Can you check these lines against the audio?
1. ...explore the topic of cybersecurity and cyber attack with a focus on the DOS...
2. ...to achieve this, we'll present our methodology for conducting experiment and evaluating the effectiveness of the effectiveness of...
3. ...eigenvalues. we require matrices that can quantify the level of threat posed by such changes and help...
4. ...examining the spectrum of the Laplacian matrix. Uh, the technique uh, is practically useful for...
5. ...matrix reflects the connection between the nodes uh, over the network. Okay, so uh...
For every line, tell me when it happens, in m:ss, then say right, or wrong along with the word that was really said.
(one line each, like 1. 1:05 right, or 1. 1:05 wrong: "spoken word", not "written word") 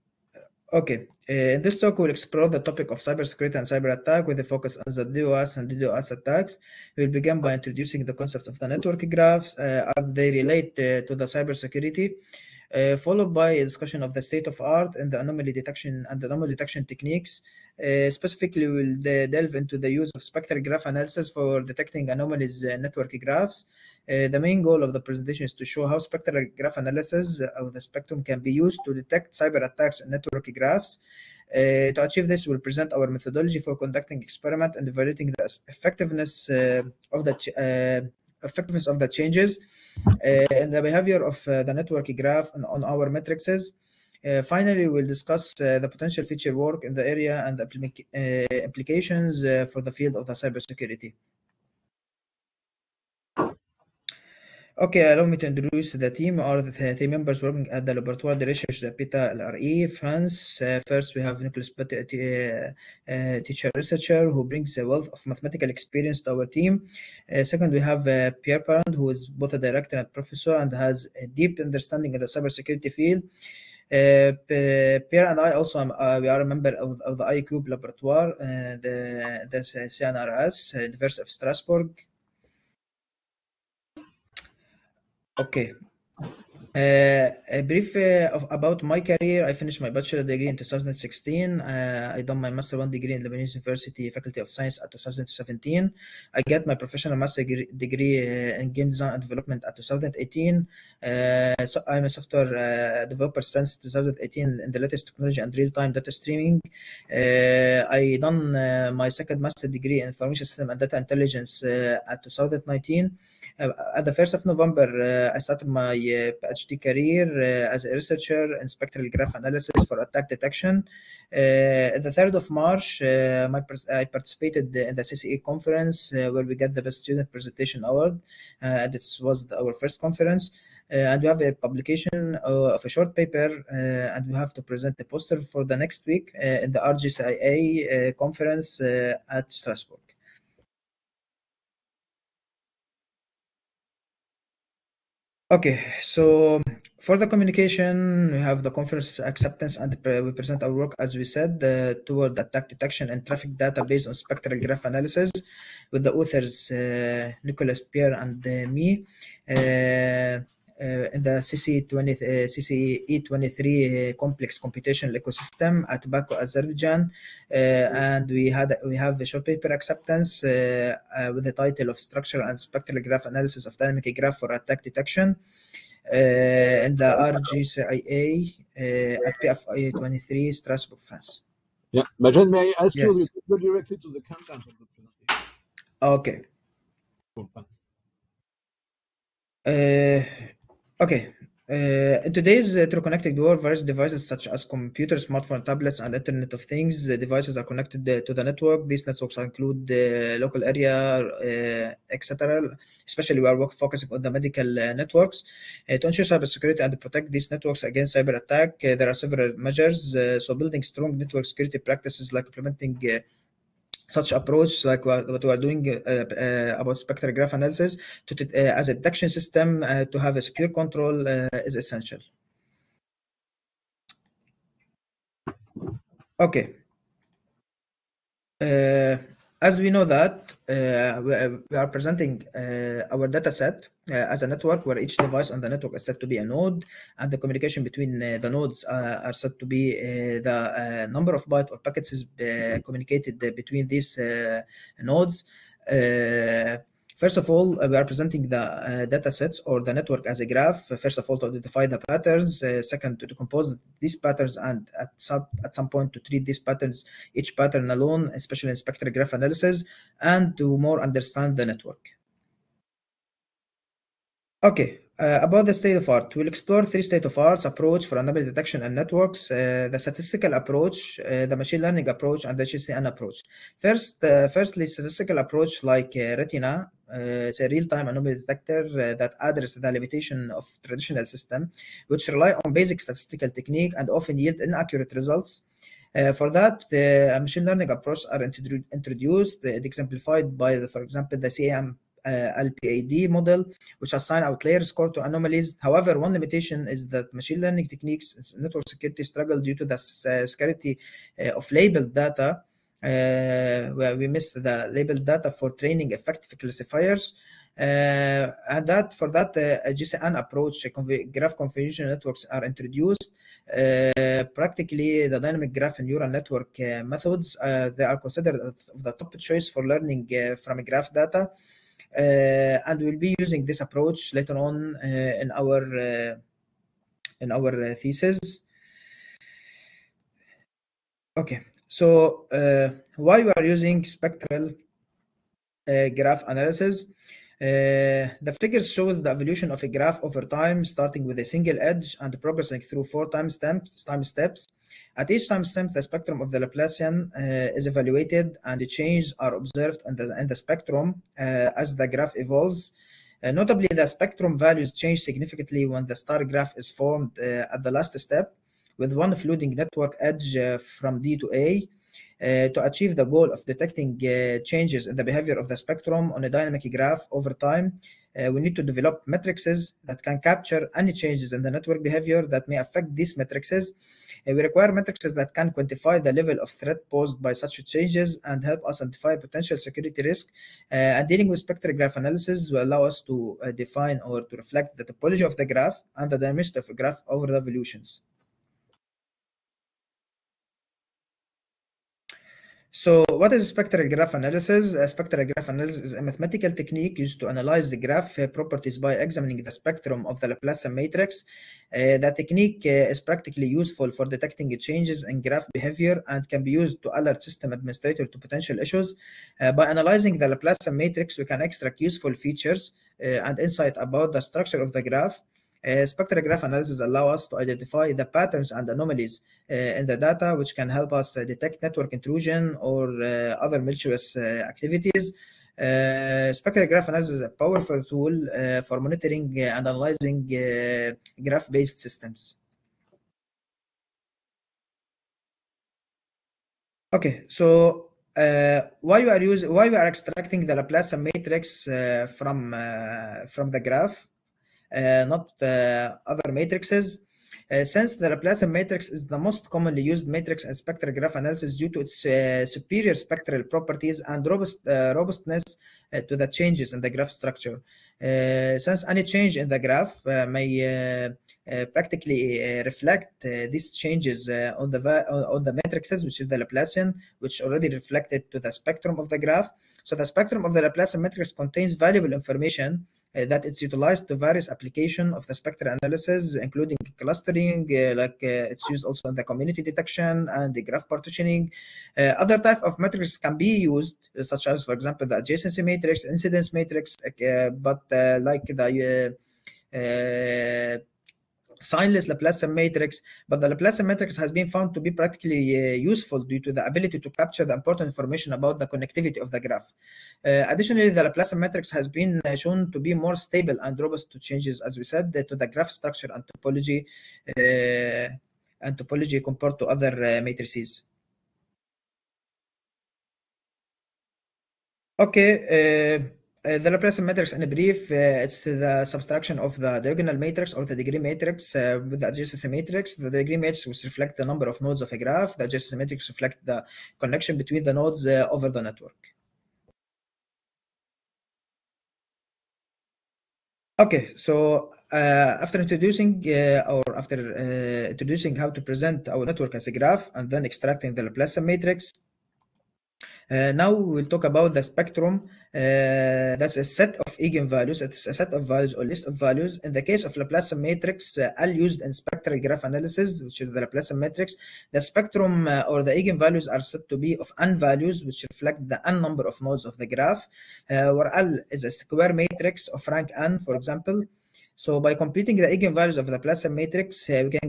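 1. 0:02 right
2. 0:31 right
3. 6:13 wrong: "matrices", not "eigenvalues"
4. 6:39 right
5. 8:46 right.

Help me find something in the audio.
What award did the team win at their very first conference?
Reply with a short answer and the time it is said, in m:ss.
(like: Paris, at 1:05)
Best Student Presentation Award, at 2:06.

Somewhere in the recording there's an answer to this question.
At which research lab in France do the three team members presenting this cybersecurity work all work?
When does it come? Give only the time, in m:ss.
0:57.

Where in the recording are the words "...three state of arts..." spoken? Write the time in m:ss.
4:26.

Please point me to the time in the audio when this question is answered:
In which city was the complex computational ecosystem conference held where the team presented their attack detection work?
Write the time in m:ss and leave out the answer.
2:46.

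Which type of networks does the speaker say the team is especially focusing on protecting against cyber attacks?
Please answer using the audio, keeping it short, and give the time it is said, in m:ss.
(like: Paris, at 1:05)
medical networks, at 3:24.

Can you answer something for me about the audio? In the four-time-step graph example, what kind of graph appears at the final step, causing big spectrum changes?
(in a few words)
star graph.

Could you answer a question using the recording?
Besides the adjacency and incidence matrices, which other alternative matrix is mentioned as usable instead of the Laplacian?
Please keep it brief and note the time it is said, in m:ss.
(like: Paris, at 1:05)
signless Laplacian matrix, at 8:11.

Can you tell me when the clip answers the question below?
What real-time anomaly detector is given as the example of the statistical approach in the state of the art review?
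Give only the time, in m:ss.
4:36.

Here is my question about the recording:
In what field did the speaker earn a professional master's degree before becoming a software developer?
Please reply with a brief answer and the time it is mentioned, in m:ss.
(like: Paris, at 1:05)
game design and development, at 1:38.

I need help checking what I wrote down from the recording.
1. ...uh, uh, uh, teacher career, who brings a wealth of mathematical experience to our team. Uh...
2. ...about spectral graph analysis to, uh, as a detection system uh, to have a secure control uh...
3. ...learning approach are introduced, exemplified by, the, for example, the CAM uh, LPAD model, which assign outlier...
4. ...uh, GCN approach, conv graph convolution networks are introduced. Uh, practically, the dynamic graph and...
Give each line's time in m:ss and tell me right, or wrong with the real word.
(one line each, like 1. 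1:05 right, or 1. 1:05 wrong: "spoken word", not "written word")
1. 1:02 wrong: "researcher", not "career"
2. 3:36 right
3. 4:47 right
4. 5:09 right.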